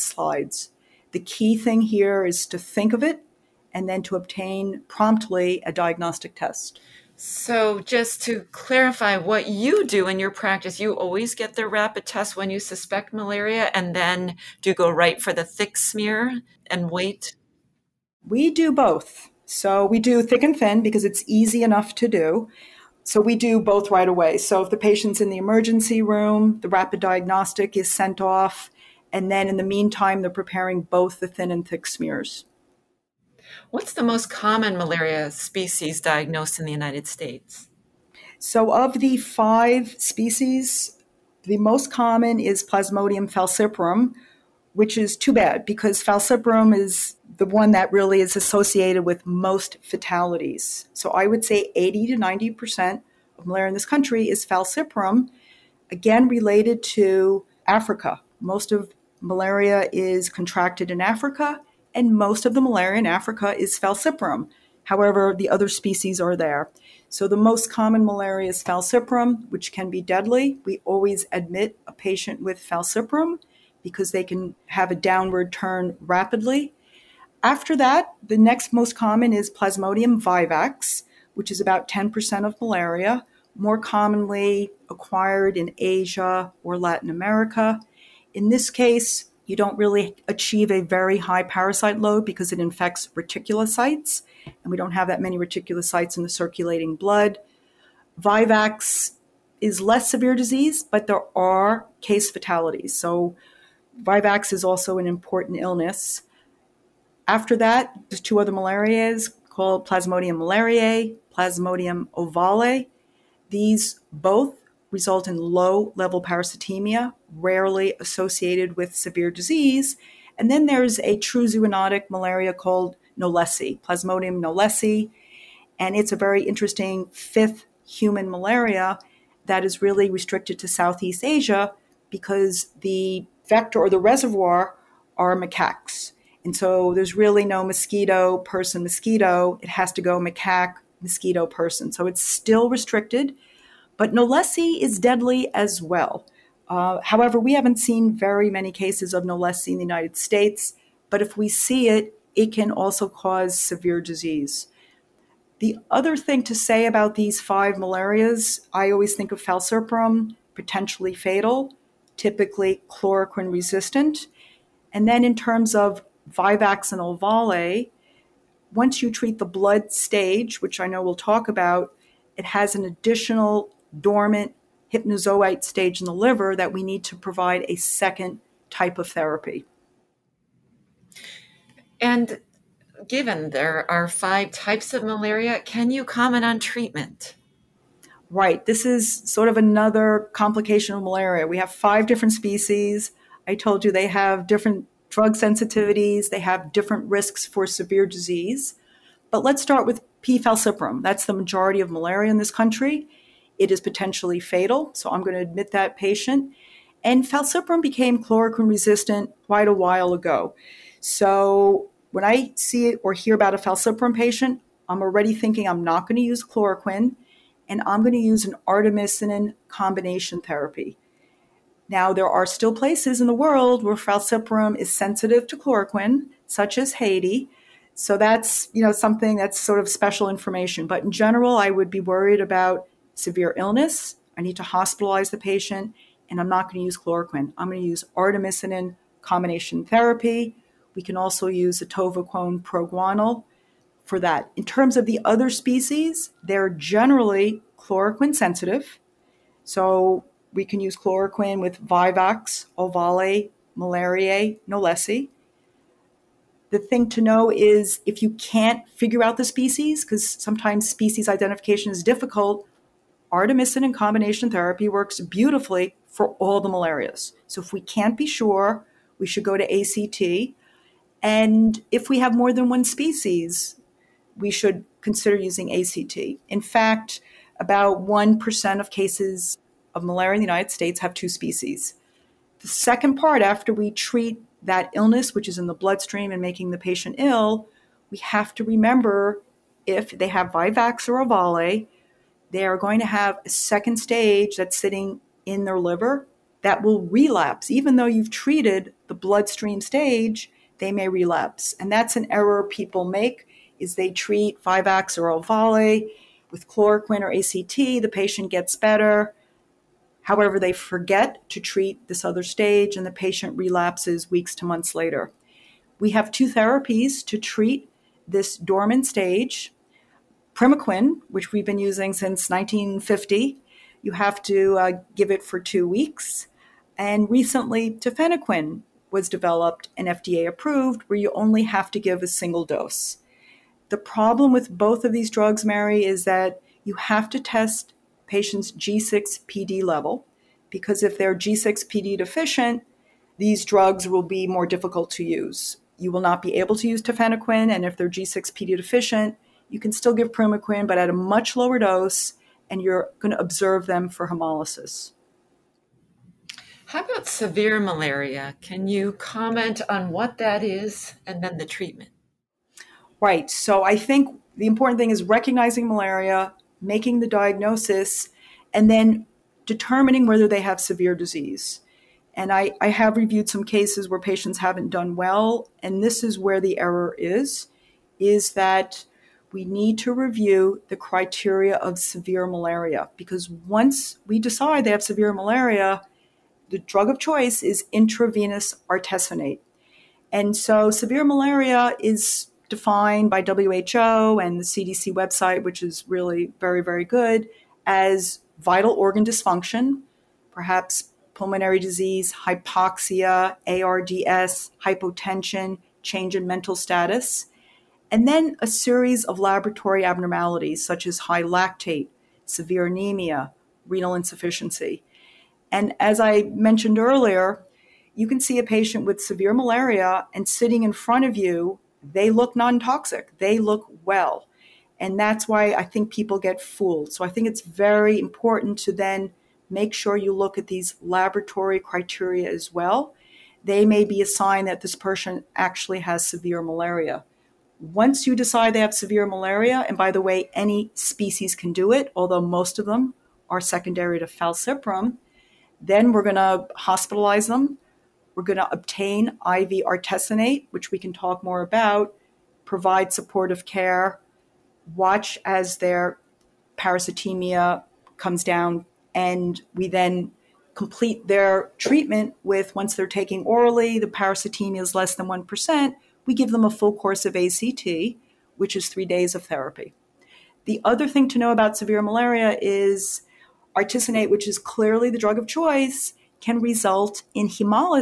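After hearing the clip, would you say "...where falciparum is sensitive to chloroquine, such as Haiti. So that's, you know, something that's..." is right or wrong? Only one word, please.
right.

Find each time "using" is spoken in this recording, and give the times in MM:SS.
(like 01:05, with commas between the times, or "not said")
04:35, 05:21.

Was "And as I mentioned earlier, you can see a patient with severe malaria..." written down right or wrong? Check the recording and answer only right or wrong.
right.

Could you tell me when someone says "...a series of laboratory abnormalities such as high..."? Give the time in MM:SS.
06:48.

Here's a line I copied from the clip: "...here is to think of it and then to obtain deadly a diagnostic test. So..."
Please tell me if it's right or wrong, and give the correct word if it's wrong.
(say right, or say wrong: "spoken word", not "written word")
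wrong: "promptly", not "deadly".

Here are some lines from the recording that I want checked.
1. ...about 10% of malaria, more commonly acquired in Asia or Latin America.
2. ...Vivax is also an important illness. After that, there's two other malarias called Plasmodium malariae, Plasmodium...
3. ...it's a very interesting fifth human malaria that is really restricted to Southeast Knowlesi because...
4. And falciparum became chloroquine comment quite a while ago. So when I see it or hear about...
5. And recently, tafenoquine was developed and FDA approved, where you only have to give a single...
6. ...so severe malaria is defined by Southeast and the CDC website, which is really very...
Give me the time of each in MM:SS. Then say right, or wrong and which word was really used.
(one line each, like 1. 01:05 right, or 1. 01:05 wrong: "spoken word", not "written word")
1. 01:21 right
2. 01:43 right
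3. 02:05 wrong: "Asia", not "Knowlesi"
4. 03:27 wrong: "resistant", not "comment"
5. 05:26 right
6. 06:30 wrong: "WHO", not "Southeast".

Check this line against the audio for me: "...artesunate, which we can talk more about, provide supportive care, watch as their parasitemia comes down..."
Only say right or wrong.
right.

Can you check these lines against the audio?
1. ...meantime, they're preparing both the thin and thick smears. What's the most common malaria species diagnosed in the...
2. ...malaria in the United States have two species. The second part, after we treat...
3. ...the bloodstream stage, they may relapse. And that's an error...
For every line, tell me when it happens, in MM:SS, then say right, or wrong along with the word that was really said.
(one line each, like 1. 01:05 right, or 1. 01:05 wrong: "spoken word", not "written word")
1. 00:29 right
2. 04:40 right
3. 04:59 right.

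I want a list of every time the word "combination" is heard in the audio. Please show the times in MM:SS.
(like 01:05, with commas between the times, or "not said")
03:39, 03:59, 04:23.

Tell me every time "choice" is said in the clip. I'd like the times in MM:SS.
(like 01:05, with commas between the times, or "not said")
06:27, 07:55.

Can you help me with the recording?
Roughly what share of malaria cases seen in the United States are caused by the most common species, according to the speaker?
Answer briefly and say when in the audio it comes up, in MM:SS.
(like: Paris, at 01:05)
80 to 90%, at 00:51.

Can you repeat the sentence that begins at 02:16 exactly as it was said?
And so there's really no mosquito, person, mosquito.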